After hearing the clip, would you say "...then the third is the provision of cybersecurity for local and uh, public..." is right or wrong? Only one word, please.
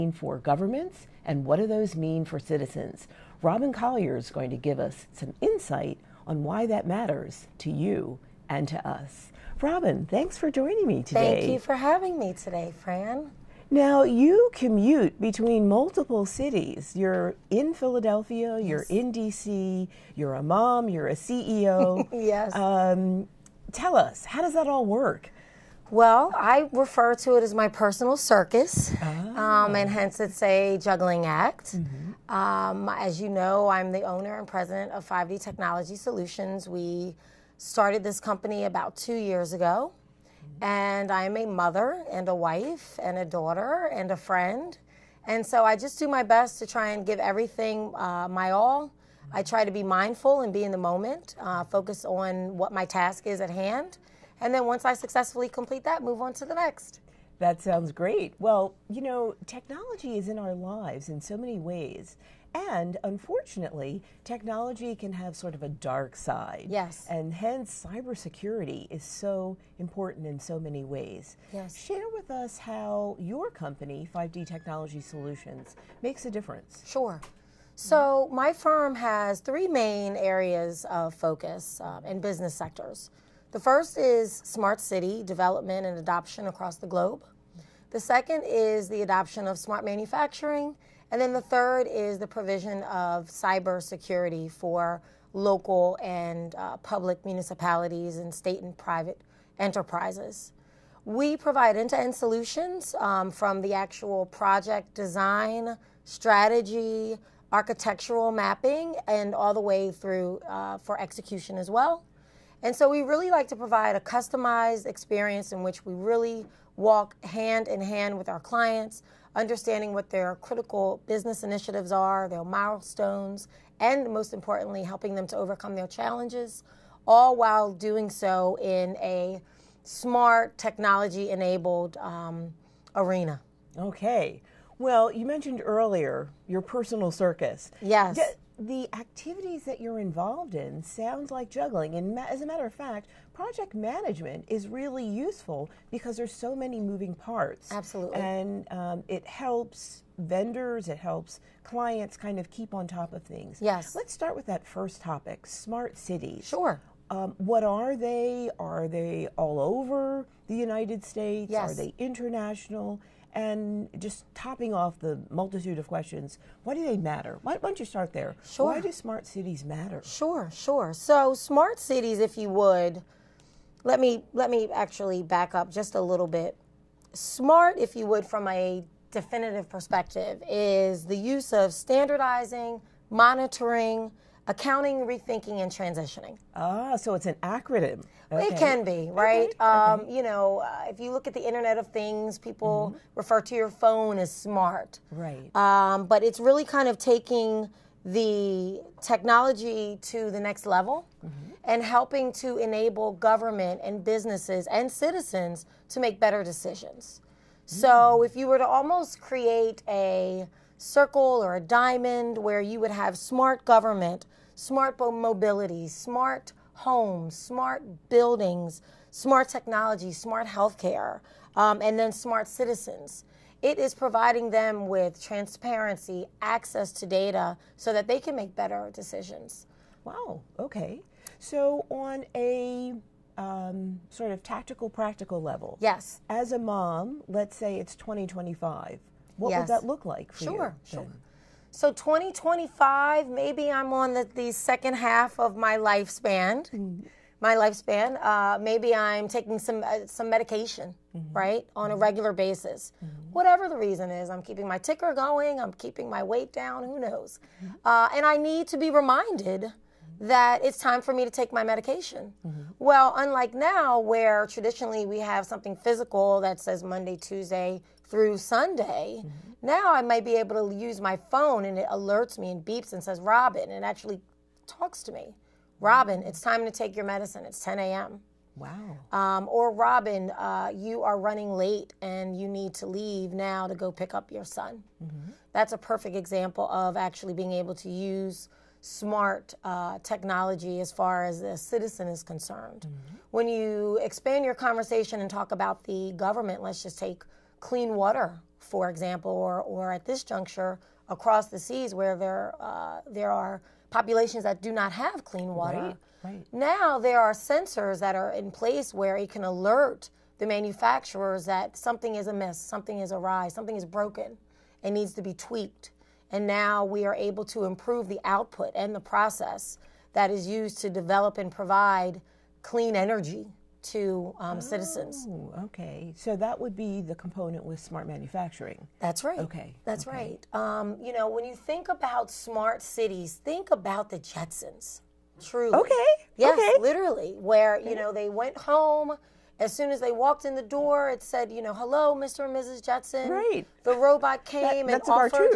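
right.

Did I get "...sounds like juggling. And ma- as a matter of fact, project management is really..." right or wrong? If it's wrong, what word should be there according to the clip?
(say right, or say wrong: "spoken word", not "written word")
right.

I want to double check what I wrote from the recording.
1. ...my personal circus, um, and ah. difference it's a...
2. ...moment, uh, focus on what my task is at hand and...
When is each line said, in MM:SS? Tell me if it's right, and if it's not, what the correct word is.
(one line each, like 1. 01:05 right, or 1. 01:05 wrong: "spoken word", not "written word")
1. 00:27 wrong: "hence", not "difference"
2. 00:50 right.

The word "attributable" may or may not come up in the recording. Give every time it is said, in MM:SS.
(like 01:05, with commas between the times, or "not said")
not said.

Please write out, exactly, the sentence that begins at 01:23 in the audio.
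The first is smart city development and adoption across the globe.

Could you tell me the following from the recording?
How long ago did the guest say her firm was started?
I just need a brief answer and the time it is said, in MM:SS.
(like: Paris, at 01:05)
about two years ago, at 00:38.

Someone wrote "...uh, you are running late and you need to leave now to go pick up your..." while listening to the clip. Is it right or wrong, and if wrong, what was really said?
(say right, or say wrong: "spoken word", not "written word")
right.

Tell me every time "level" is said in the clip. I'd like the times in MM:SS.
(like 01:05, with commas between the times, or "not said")
03:20, 03:55.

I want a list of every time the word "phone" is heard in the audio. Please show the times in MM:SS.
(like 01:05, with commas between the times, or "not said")
03:13, 04:31.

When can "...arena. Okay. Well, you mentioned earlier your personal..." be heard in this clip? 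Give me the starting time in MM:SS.
02:12.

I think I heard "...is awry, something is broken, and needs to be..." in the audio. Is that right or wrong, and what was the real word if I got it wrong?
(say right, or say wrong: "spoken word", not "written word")
right.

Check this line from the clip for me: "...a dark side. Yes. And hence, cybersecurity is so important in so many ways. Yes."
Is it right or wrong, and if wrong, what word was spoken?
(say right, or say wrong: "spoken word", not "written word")
right.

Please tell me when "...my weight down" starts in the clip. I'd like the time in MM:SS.
04:16.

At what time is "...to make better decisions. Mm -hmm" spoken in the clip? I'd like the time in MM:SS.
03:25.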